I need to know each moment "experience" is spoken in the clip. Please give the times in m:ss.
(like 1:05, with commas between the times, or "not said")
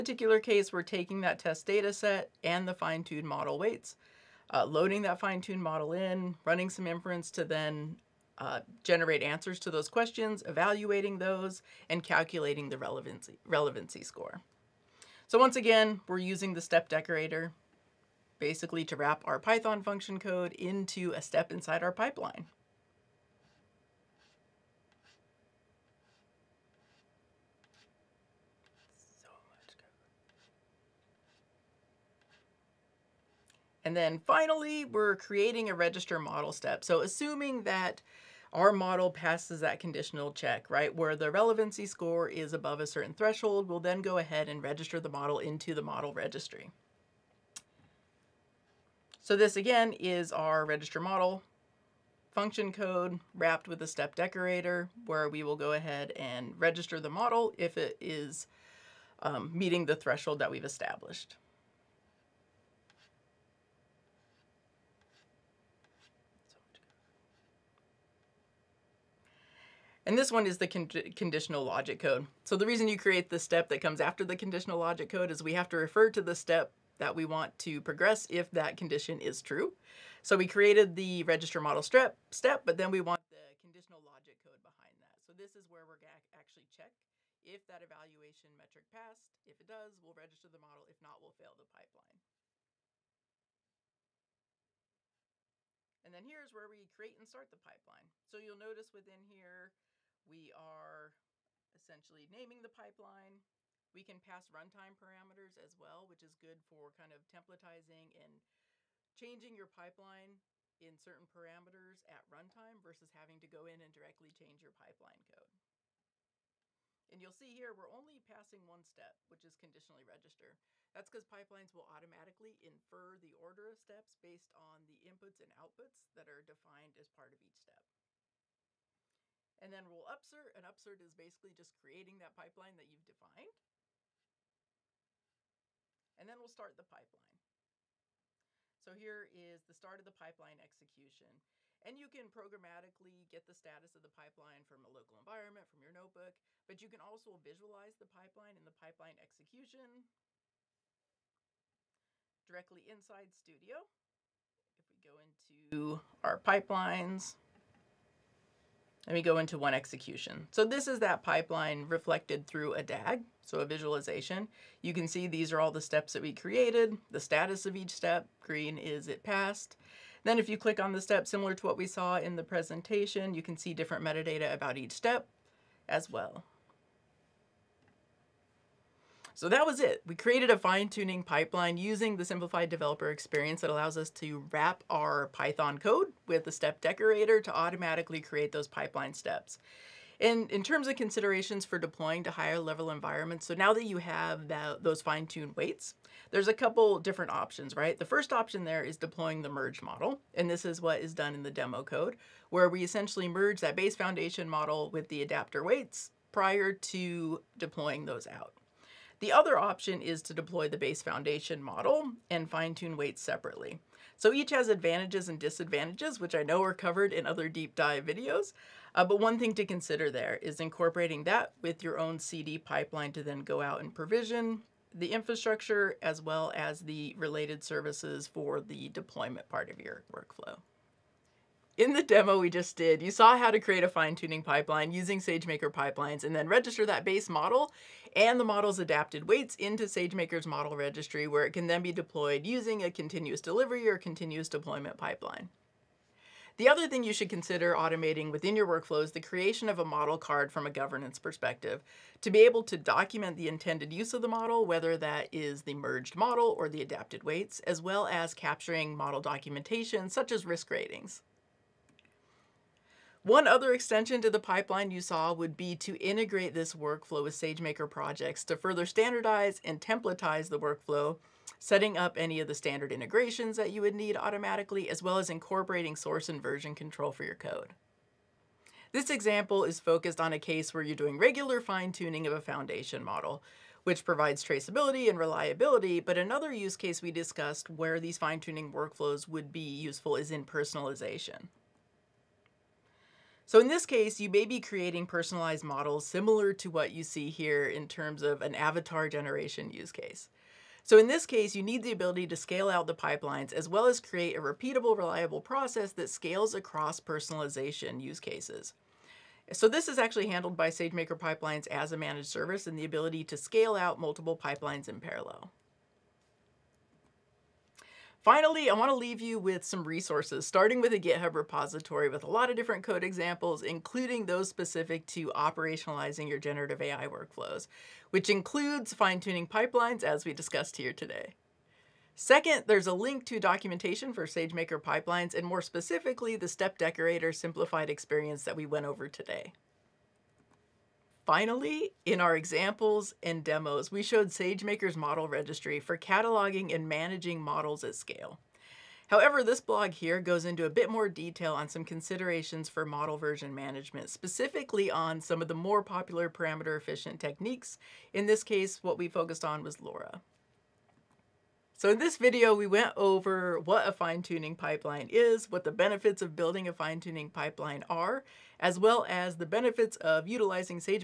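3:03, 5:37.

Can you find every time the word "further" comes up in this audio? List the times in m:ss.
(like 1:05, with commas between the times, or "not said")
4:28.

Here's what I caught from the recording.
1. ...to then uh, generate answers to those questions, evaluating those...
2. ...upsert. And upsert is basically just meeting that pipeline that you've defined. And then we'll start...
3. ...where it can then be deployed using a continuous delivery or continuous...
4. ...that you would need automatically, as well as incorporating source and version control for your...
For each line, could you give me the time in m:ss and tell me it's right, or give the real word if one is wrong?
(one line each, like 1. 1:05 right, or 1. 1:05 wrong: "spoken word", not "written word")
1. 0:07 right
2. 2:10 wrong: "creating", not "meeting"
3. 4:01 right
4. 4:33 right.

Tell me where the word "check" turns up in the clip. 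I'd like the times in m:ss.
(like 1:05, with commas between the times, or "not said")
0:40, 1:26.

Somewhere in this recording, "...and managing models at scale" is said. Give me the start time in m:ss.
5:46.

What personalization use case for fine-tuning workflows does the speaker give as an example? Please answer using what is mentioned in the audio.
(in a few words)
avatar generation.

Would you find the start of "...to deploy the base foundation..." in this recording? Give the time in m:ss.
3:30.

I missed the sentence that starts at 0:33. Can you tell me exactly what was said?
And then finally, we're creating a register model step.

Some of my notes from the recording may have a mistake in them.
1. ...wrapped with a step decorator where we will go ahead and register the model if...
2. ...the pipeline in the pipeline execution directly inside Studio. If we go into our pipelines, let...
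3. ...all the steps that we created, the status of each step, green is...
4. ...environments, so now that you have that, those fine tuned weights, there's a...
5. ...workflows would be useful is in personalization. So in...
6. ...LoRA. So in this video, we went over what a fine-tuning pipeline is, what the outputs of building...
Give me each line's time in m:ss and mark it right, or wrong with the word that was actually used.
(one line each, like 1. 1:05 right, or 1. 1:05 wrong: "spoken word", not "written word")
1. 0:53 right
2. 2:27 right
3. 2:45 right
4. 3:12 right
5. 4:48 right
6. 5:59 wrong: "benefits", not "outputs".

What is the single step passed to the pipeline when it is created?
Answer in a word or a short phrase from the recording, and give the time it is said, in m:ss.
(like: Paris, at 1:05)
conditionally register, at 1:59.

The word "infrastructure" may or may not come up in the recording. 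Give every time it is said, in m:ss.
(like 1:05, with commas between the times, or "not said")
3:45.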